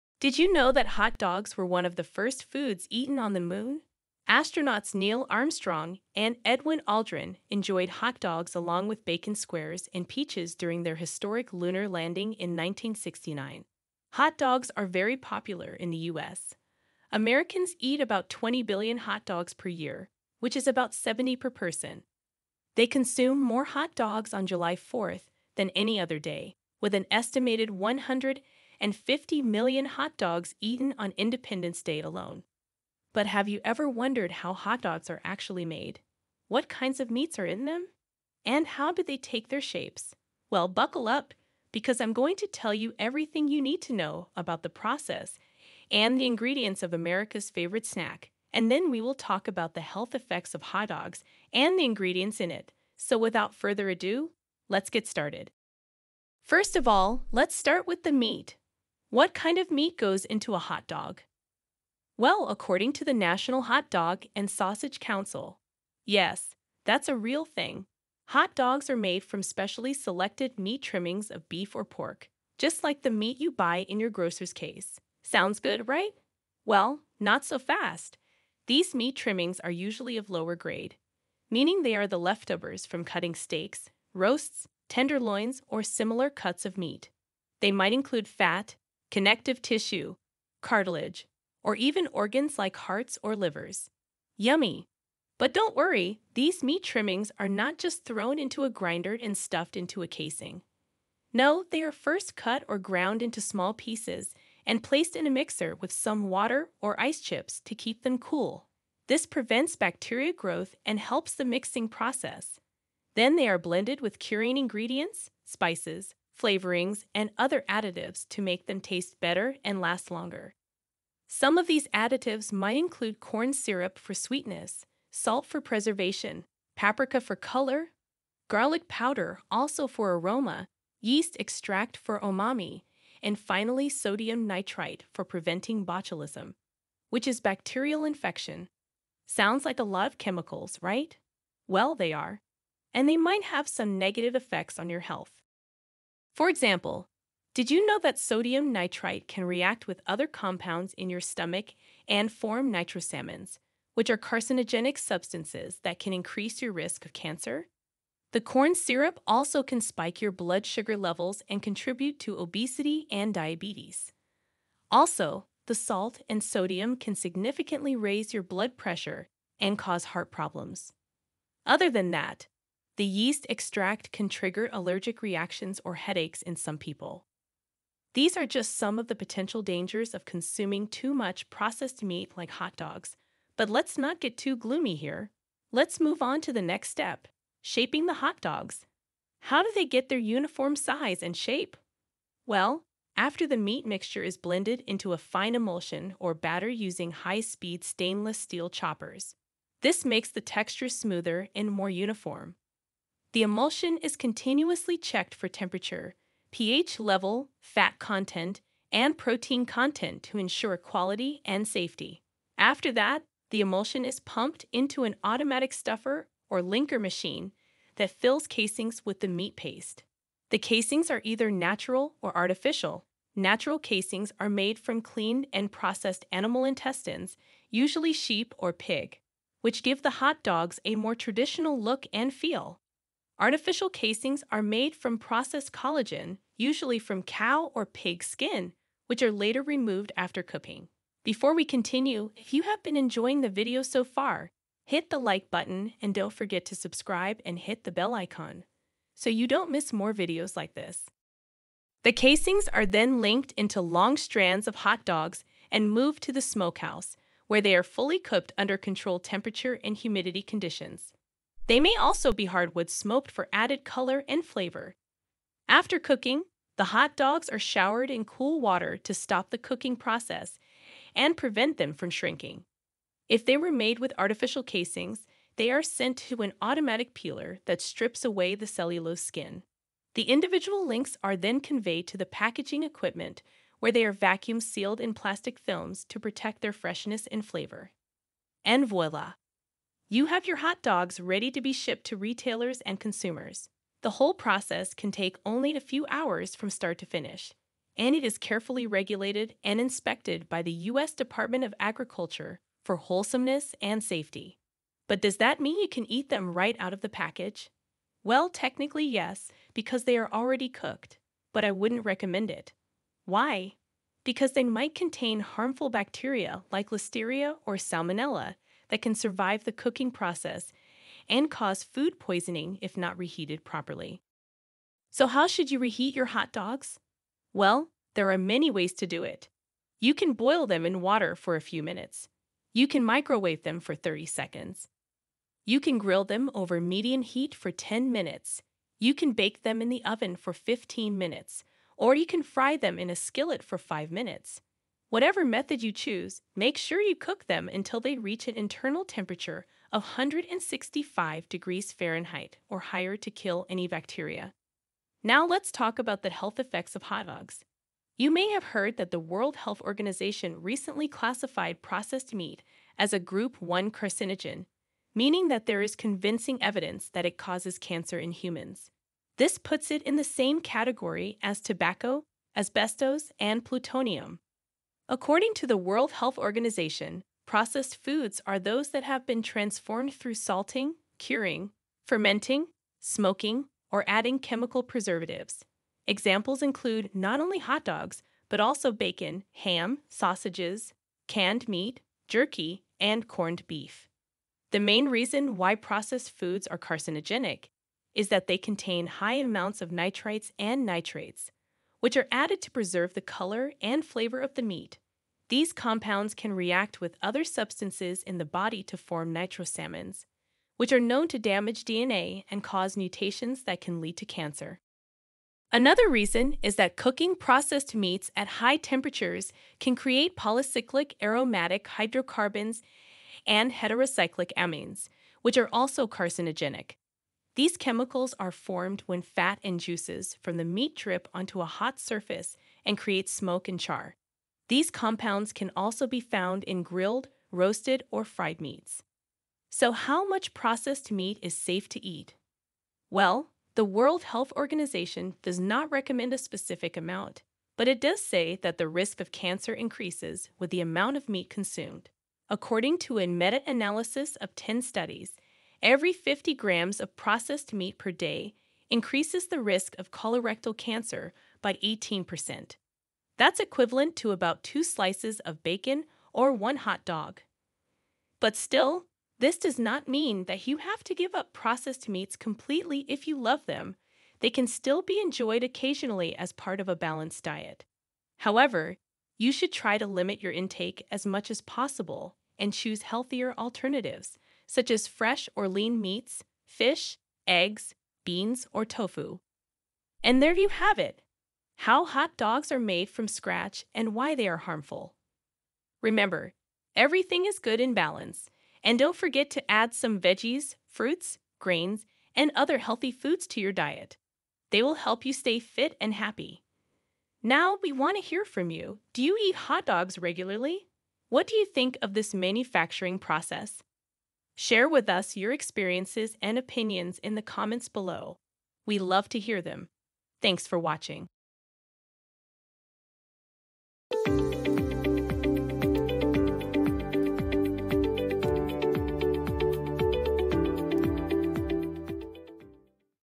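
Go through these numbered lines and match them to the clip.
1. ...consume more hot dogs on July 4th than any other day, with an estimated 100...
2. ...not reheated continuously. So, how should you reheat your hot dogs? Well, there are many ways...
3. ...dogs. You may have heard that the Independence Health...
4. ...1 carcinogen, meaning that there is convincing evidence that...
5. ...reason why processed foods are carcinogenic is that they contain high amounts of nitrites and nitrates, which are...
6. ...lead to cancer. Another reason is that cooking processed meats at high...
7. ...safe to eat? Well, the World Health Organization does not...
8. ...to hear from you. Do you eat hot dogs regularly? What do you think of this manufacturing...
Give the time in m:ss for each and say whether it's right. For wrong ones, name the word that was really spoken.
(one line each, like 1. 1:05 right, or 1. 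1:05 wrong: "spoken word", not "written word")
1. 0:22 right
2. 5:22 wrong: "properly", not "continuously"
3. 5:57 wrong: "World", not "Independence"
4. 6:03 right
5. 6:35 right
6. 6:54 right
7. 7:21 right
8. 8:28 right.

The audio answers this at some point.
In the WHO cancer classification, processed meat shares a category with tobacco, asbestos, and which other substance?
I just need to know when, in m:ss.
6:13.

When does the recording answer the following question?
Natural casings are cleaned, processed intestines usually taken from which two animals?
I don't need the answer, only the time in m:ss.
3:48.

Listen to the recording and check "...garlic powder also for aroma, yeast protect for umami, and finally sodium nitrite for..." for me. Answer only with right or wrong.
wrong.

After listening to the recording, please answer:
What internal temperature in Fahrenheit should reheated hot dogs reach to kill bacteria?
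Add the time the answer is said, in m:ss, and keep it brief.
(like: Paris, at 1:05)
165 degrees, at 5:50.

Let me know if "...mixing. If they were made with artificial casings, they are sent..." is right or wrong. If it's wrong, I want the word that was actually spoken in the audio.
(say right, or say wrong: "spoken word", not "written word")
wrong: "shrinking", not "mixing".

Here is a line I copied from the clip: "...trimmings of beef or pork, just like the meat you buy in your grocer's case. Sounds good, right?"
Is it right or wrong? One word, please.
right.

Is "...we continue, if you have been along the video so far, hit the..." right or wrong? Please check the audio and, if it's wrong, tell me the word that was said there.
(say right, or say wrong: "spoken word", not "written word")
wrong: "enjoying", not "along".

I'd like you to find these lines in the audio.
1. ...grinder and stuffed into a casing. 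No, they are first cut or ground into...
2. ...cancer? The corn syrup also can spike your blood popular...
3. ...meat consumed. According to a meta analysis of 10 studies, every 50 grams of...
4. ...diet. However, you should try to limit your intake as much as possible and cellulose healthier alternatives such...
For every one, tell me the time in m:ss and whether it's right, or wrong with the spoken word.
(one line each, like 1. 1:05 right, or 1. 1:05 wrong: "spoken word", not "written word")
1. 1:38 right
2. 2:37 wrong: "sugar", not "popular"
3. 7:31 right
4. 7:57 wrong: "choose", not "cellulose".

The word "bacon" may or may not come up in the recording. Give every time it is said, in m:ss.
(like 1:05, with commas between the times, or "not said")
0:09, 6:28, 7:45.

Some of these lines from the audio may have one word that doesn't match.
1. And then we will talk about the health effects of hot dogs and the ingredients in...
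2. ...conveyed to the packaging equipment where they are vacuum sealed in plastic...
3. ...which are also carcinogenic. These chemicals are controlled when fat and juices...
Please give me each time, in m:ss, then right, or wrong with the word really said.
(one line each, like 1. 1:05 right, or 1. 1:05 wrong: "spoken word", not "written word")
1. 0:48 right
2. 4:41 right
3. 7:05 wrong: "formed", not "controlled".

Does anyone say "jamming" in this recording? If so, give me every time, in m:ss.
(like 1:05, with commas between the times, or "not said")
not said.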